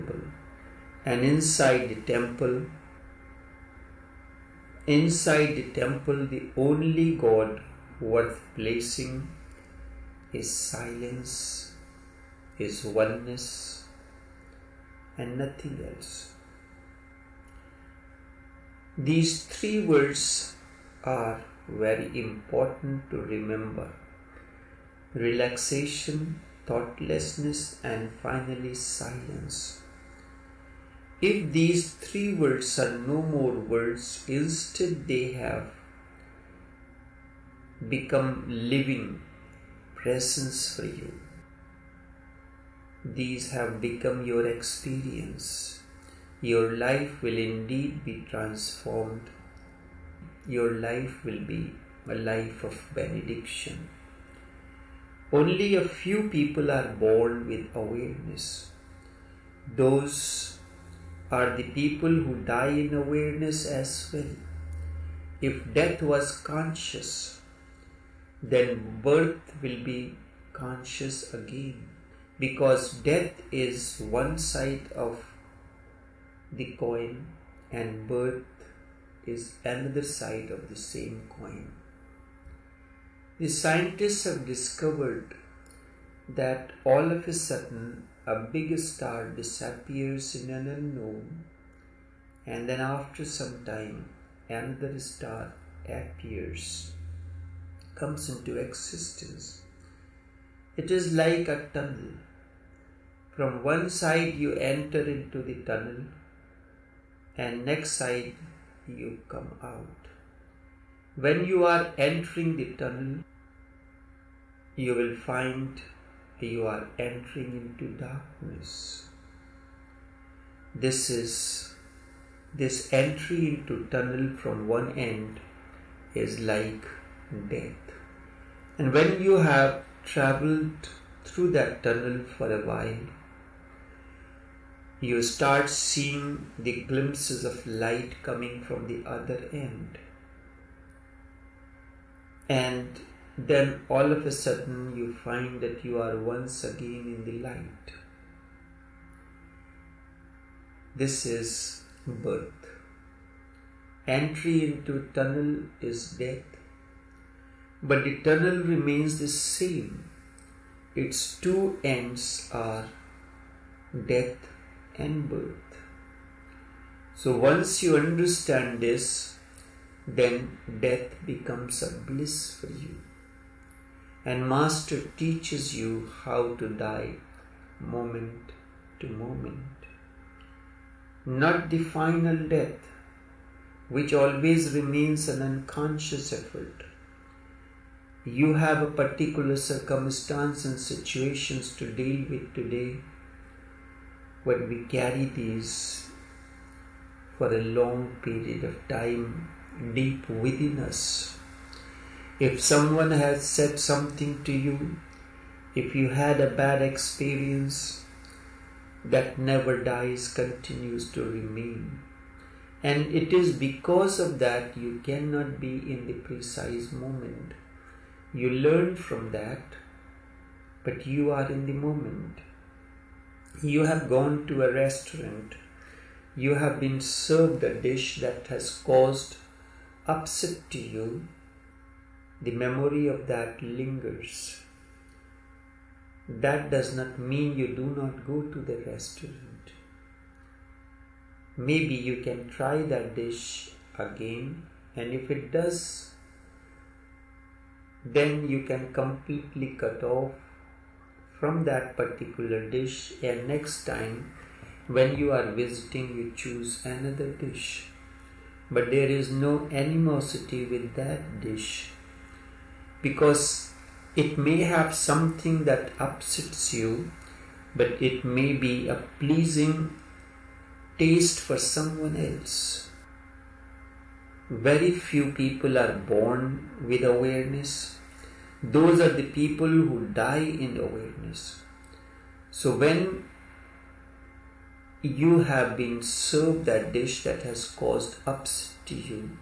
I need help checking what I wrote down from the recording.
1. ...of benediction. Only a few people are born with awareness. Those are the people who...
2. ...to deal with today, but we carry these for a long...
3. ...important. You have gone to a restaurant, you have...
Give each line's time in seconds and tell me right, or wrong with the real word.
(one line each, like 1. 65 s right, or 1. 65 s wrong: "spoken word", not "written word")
1. 52 s right
2. 191 s right
3. 221 s wrong: "moment", not "important".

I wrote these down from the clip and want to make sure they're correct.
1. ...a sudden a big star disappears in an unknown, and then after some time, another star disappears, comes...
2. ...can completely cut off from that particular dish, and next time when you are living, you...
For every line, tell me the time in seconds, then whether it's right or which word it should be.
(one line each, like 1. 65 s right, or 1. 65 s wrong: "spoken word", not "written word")
1. 87 s wrong: "appears", not "disappears"
2. 248 s wrong: "visiting", not "living".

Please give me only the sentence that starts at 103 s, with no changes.
From one side, you enter into the tunnel, and next side, you come out.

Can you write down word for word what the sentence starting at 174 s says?
And Master teaches you how to die moment to moment.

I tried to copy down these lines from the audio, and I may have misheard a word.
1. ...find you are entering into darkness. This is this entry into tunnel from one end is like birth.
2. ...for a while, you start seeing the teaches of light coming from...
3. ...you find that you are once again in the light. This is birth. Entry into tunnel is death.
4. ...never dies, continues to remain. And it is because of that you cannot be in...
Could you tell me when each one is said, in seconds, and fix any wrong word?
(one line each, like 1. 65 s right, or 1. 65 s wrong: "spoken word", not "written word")
1. 115 s wrong: "death", not "birth"
2. 132 s wrong: "glimpses", not "teaches"
3. 144 s right
4. 209 s right.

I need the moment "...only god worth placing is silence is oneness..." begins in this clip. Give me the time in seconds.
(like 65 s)
6 s.